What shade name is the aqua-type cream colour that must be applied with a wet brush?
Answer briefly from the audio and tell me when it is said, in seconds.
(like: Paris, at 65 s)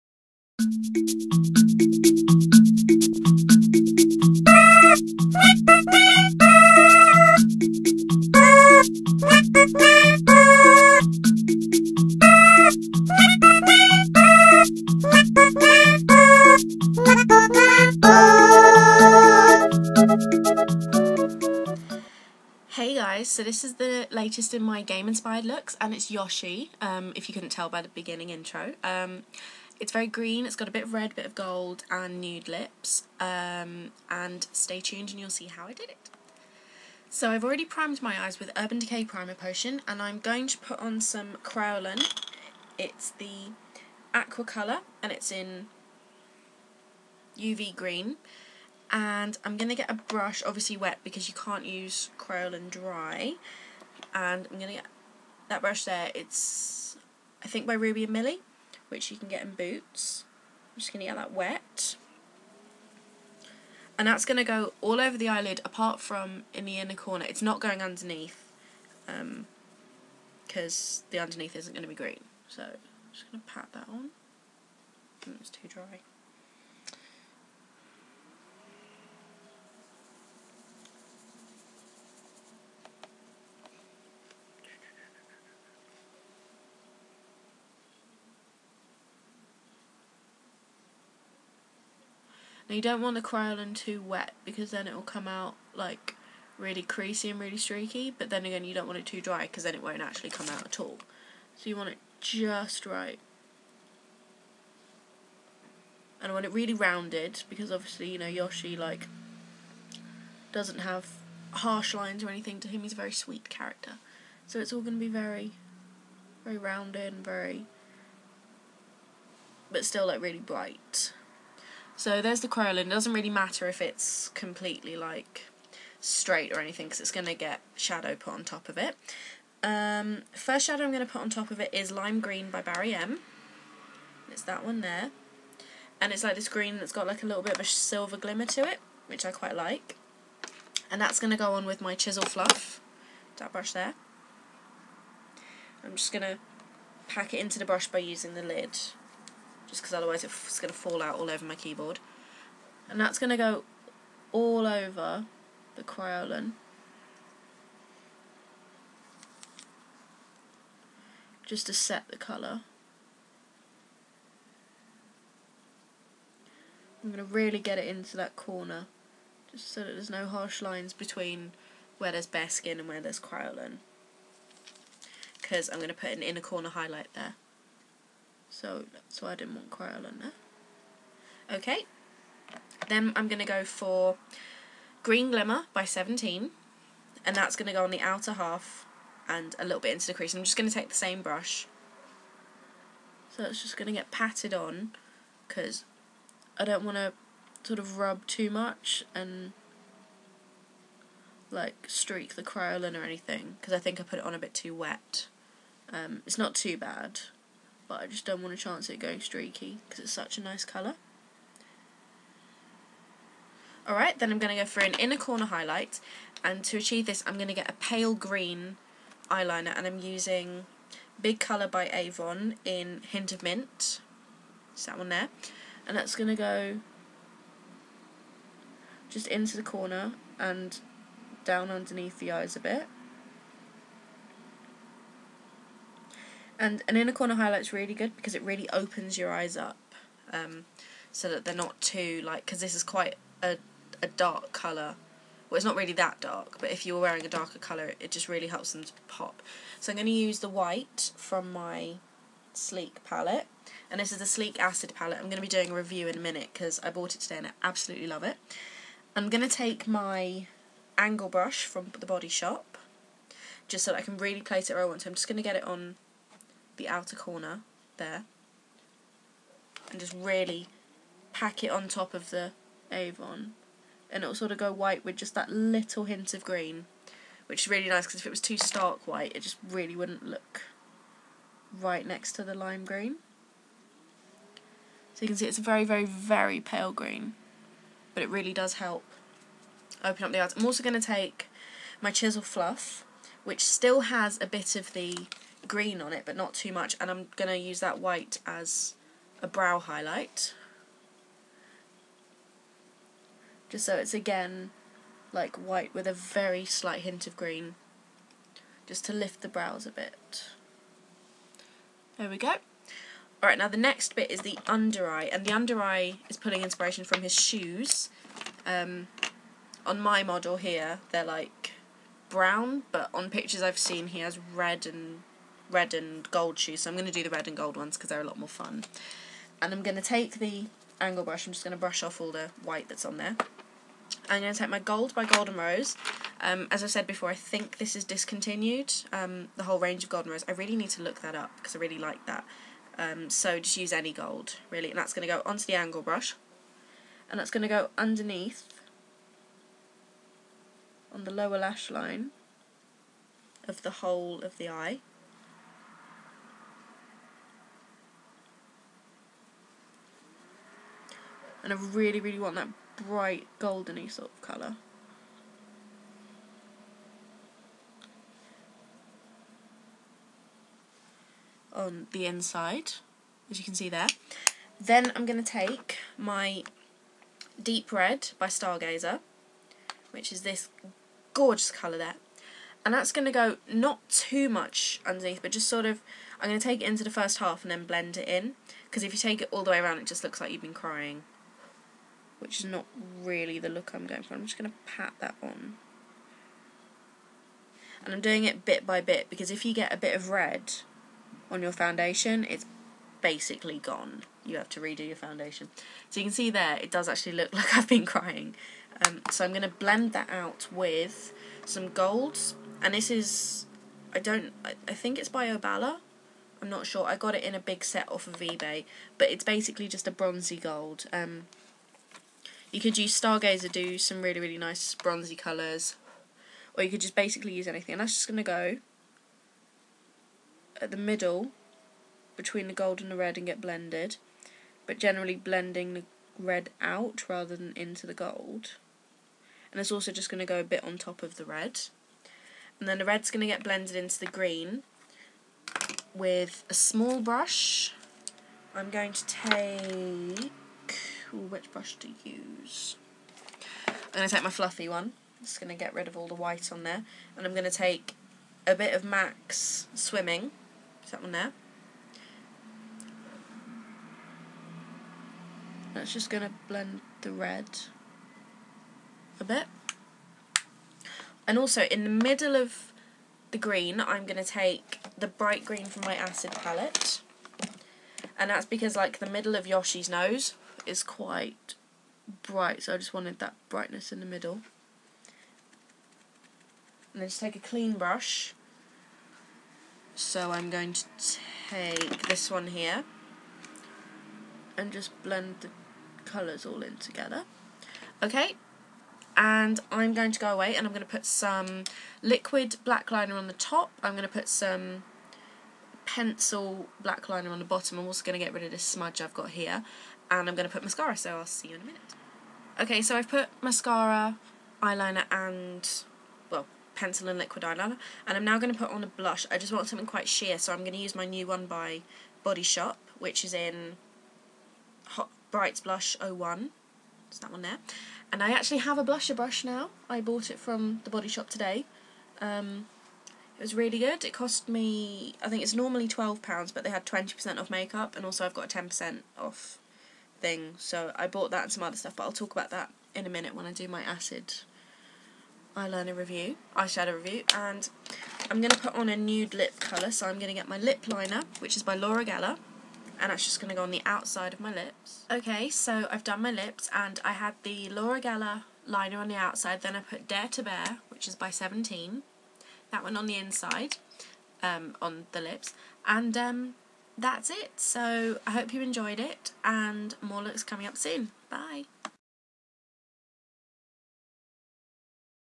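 UV green, at 47 s.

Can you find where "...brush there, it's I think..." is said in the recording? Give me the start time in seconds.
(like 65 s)
55 s.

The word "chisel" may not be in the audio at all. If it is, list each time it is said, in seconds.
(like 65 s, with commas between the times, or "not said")
141 s, 292 s.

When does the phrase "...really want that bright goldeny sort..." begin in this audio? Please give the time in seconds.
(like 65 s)
362 s.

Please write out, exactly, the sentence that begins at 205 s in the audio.
Um, it's not too bad, but I just don't want to chance it going streaky because it's such a nice colour.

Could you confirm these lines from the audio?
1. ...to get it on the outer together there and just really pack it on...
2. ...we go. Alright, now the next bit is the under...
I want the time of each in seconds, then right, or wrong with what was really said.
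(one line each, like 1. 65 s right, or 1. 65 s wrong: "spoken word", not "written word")
1. 265 s wrong: "corner", not "together"
2. 312 s right.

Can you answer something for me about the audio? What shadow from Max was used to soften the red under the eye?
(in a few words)
Swimming.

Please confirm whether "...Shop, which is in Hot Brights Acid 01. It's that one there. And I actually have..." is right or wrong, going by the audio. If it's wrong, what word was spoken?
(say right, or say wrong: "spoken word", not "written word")
wrong: "Blush", not "Acid".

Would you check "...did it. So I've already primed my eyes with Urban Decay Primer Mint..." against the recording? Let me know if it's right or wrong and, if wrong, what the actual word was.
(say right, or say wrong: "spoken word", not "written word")
wrong: "Potion", not "Mint".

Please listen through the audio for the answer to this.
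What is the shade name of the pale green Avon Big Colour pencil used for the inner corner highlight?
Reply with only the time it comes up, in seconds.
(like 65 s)
223 s.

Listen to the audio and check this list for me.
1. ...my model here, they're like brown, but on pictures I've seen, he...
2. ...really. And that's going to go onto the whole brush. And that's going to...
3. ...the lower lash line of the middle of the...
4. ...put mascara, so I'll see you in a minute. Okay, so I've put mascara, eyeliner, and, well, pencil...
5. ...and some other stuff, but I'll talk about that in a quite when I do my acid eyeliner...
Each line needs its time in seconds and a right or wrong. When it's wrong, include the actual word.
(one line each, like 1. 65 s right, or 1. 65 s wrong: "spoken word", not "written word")
1. 319 s right
2. 344 s wrong: "angle", not "whole"
3. 351 s wrong: "whole", not "middle"
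4. 510 s right
5. 541 s wrong: "minute", not "quite".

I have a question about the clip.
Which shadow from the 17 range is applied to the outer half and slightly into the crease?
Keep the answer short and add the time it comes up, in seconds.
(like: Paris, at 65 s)
Green Glimmer, at 185 s.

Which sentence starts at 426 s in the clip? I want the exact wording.
Or you could just basically use anything.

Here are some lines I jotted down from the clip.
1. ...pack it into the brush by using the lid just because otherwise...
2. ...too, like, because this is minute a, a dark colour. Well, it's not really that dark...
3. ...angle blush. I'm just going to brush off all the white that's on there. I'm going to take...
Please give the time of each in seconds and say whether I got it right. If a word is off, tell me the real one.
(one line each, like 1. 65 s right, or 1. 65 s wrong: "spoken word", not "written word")
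1. 147 s right
2. 241 s wrong: "quite", not "minute"
3. 330 s wrong: "brush", not "blush".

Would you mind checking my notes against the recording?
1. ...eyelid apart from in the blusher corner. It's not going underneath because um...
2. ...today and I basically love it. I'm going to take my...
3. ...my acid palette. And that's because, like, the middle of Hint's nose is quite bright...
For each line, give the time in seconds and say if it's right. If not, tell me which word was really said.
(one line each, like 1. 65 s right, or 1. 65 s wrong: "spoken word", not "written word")
1. 65 s wrong: "inner", not "blusher"
2. 257 s wrong: "absolutely", not "basically"
3. 476 s wrong: "Yoshi", not "Hint".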